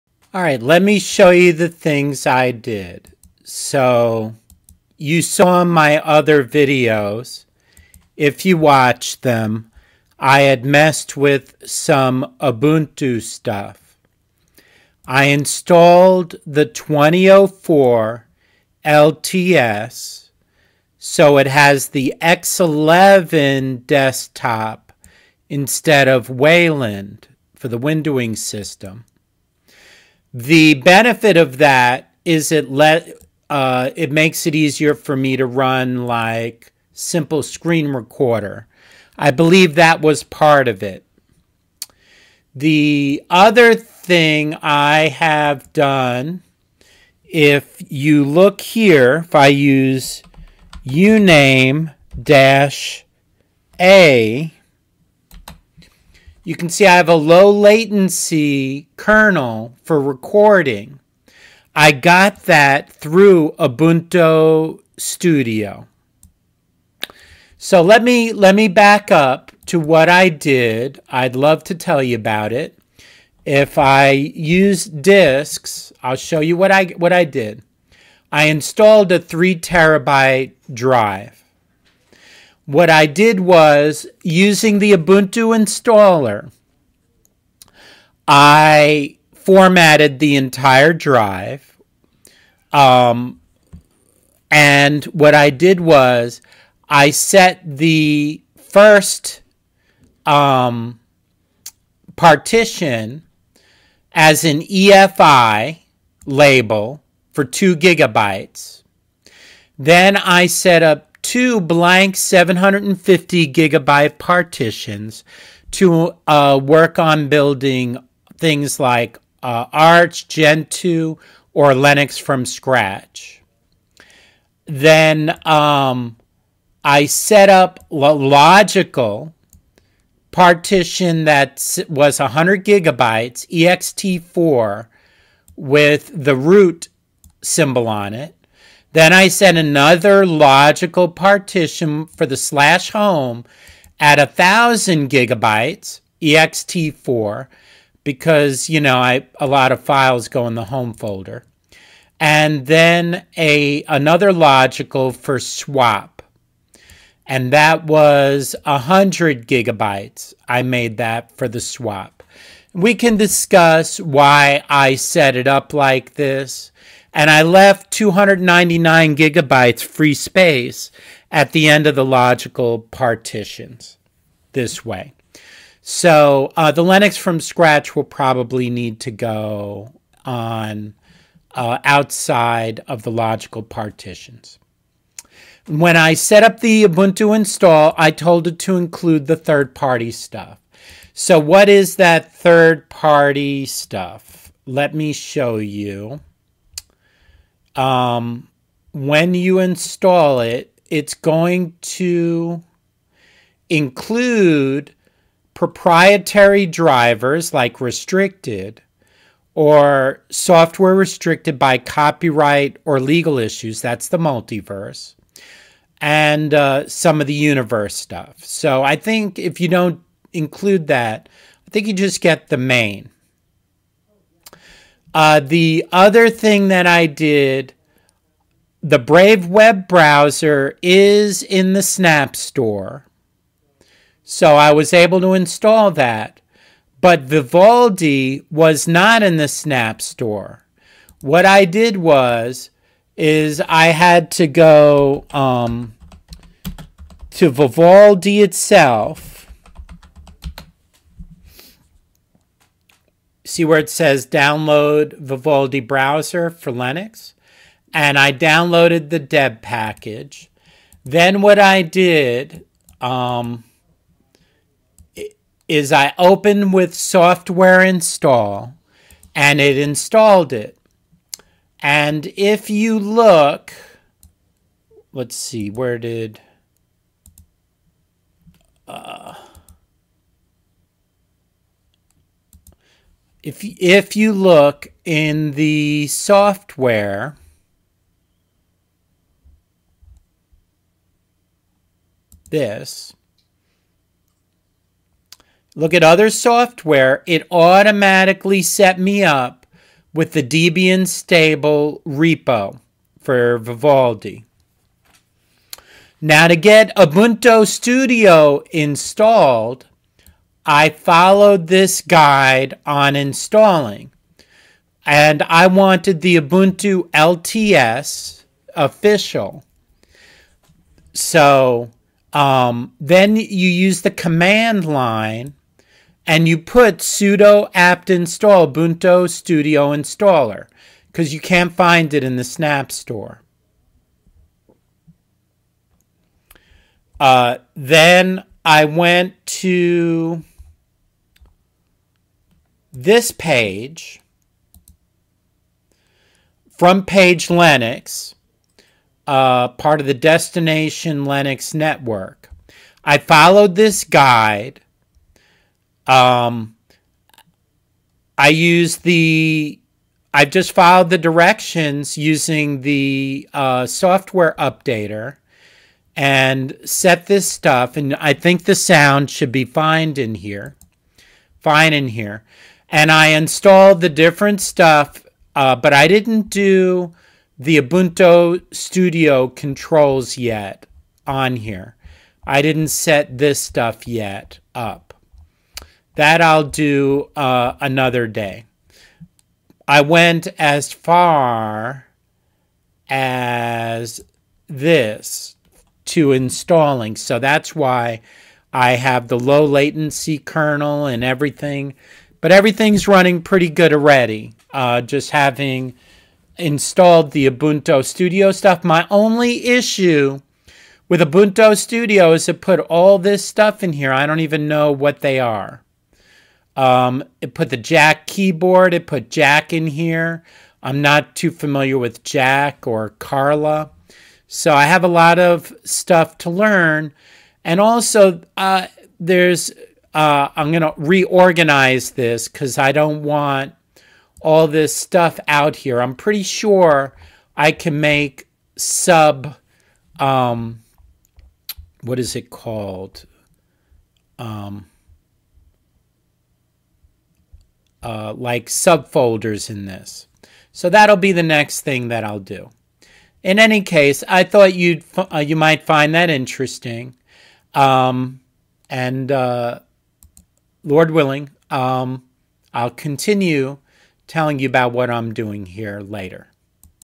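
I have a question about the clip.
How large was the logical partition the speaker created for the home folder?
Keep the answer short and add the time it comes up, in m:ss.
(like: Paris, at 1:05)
1,000 gigabytes, at 2:24.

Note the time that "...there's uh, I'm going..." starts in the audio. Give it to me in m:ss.
7:09.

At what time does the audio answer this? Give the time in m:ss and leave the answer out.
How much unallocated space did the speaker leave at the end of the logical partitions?
2:47.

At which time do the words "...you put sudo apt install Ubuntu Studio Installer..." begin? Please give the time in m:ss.
5:26.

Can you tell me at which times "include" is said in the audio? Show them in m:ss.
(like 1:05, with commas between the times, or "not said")
3:08, 3:23, 3:40.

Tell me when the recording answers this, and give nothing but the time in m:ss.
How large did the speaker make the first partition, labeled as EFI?
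1:47.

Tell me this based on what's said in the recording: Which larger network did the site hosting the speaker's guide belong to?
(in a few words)
Destination Linux.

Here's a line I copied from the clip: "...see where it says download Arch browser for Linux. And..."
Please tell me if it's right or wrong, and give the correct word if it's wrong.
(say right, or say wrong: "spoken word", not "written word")
wrong: "Vivaldi", not "Arch".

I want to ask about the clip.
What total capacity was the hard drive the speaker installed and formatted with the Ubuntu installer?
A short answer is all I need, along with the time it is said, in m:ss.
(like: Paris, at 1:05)
3 terabytes, at 1:19.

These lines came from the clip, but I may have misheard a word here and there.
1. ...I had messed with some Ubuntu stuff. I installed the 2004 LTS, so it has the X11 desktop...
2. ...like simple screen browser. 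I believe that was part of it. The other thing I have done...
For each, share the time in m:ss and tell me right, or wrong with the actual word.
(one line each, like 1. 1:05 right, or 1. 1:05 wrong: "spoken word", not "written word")
1. 0:10 right
2. 0:36 wrong: "recorder", not "browser".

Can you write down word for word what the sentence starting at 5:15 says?
And I wanted the Ubuntu LTS official.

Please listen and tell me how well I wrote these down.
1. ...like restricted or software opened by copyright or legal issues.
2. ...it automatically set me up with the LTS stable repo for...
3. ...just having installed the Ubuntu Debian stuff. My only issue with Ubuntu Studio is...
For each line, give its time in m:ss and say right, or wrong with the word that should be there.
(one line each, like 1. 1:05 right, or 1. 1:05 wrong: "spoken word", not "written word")
1. 3:27 wrong: "restricted", not "opened"
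2. 4:57 wrong: "Debian", not "LTS"
3. 6:45 wrong: "Studio", not "Debian".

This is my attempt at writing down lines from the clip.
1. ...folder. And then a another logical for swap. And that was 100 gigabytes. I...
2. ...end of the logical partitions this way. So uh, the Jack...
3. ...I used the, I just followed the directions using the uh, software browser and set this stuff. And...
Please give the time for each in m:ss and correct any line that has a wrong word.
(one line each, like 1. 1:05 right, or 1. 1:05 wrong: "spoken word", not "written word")
1. 2:30 right
2. 2:51 wrong: "Linux", not "Jack"
3. 5:58 wrong: "updater", not "browser".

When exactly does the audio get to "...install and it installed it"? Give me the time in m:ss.
4:27.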